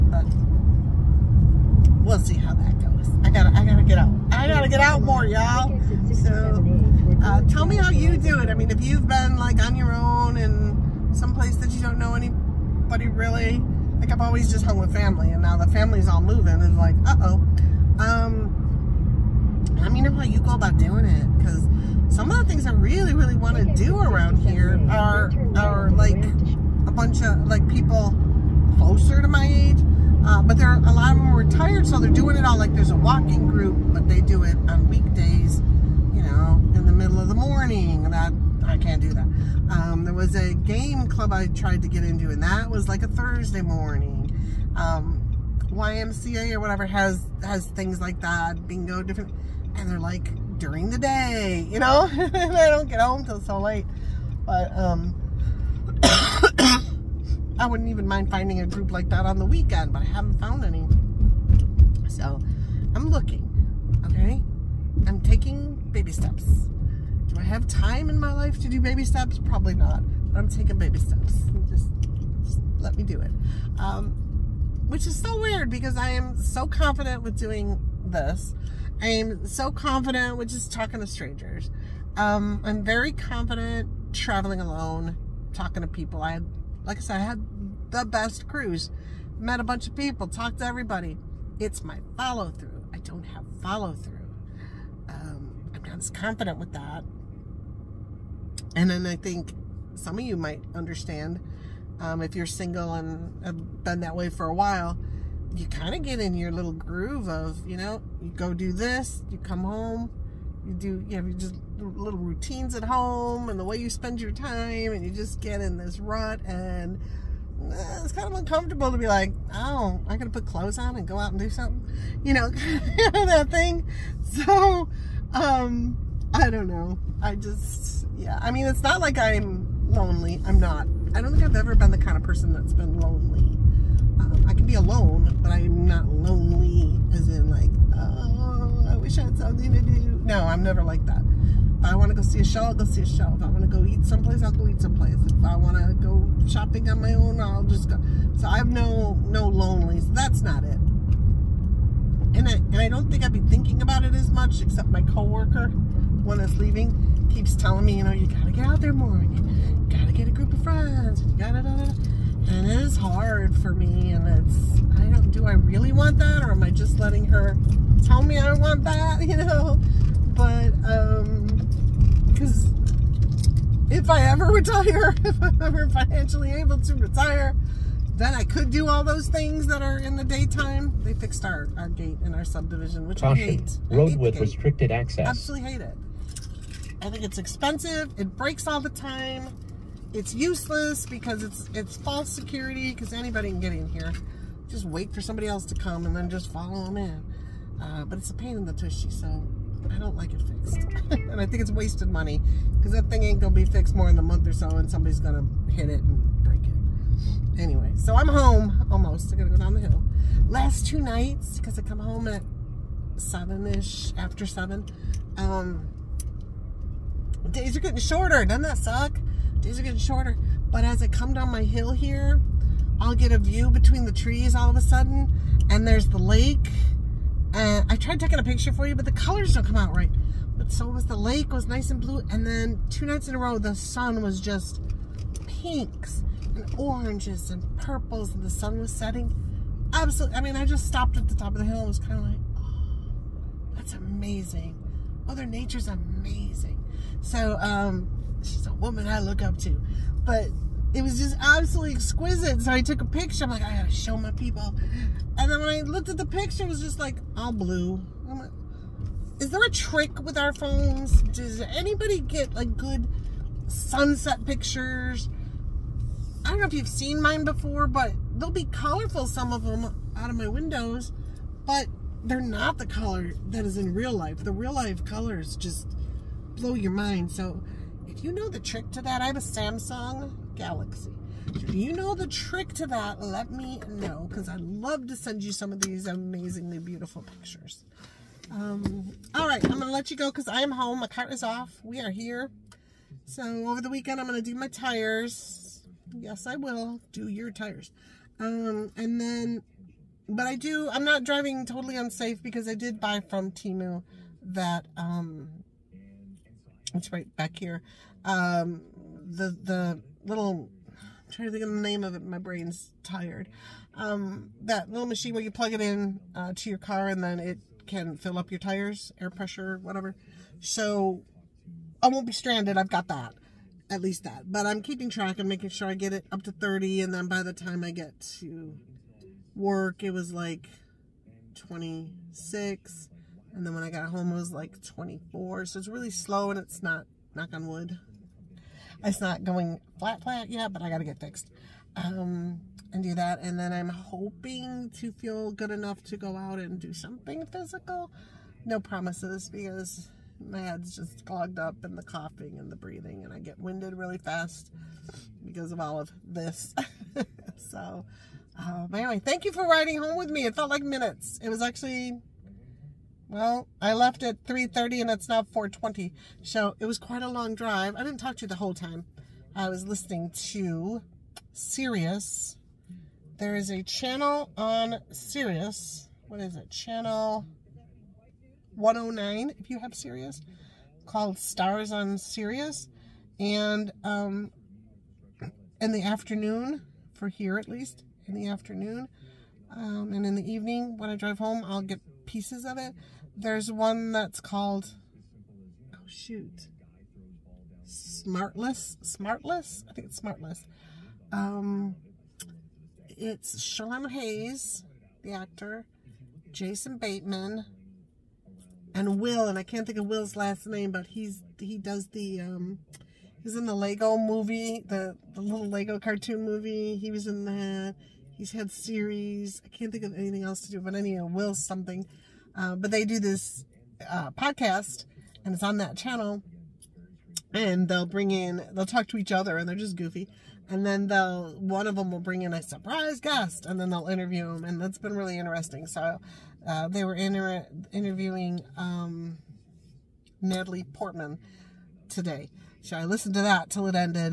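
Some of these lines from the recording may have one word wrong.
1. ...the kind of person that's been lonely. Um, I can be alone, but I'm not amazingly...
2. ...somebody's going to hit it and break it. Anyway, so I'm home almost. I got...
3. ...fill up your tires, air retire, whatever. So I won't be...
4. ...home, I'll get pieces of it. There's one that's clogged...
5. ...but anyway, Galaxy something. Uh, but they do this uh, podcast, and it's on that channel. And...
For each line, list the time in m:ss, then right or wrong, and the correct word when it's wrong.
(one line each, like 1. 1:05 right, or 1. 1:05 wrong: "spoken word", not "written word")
1. 2:11 wrong: "lonely", not "amazingly"
2. 3:24 right
3. 5:18 wrong: "pressure", not "retire"
4. 6:31 wrong: "called", not "clogged"
5. 7:00 wrong: "Will", not "Galaxy".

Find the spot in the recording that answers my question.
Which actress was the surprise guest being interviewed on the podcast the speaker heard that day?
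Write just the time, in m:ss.
7:20.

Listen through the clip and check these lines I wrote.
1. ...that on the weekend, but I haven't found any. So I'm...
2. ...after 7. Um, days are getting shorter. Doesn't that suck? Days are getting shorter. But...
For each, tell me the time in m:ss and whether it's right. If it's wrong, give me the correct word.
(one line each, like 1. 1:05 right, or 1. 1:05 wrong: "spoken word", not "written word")
1. 0:59 right
2. 3:34 right.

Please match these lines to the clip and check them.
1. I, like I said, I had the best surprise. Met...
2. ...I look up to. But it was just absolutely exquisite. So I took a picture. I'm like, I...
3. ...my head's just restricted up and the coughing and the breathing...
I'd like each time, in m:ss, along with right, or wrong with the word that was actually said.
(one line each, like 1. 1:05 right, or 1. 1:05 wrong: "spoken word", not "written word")
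1. 1:26 wrong: "cruise", not "surprise"
2. 4:09 right
3. 5:50 wrong: "clogged", not "restricted".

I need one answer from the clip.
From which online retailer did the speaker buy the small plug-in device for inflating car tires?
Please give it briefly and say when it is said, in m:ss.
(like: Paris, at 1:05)
Temu, at 5:03.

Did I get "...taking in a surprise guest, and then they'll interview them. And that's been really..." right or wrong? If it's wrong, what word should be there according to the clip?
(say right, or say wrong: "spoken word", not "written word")
wrong: "bring", not "taking".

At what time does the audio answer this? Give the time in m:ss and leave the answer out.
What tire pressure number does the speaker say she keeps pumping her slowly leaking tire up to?
5:26.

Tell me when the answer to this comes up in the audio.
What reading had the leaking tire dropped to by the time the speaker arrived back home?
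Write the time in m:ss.
5:34.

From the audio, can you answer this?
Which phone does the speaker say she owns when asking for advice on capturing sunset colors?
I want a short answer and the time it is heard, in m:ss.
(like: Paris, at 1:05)
Samsung Galaxy, at 4:39.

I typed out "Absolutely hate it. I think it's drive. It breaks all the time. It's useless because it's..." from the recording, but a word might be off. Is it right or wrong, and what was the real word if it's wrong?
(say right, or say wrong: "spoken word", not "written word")
wrong: "expensive", not "drive".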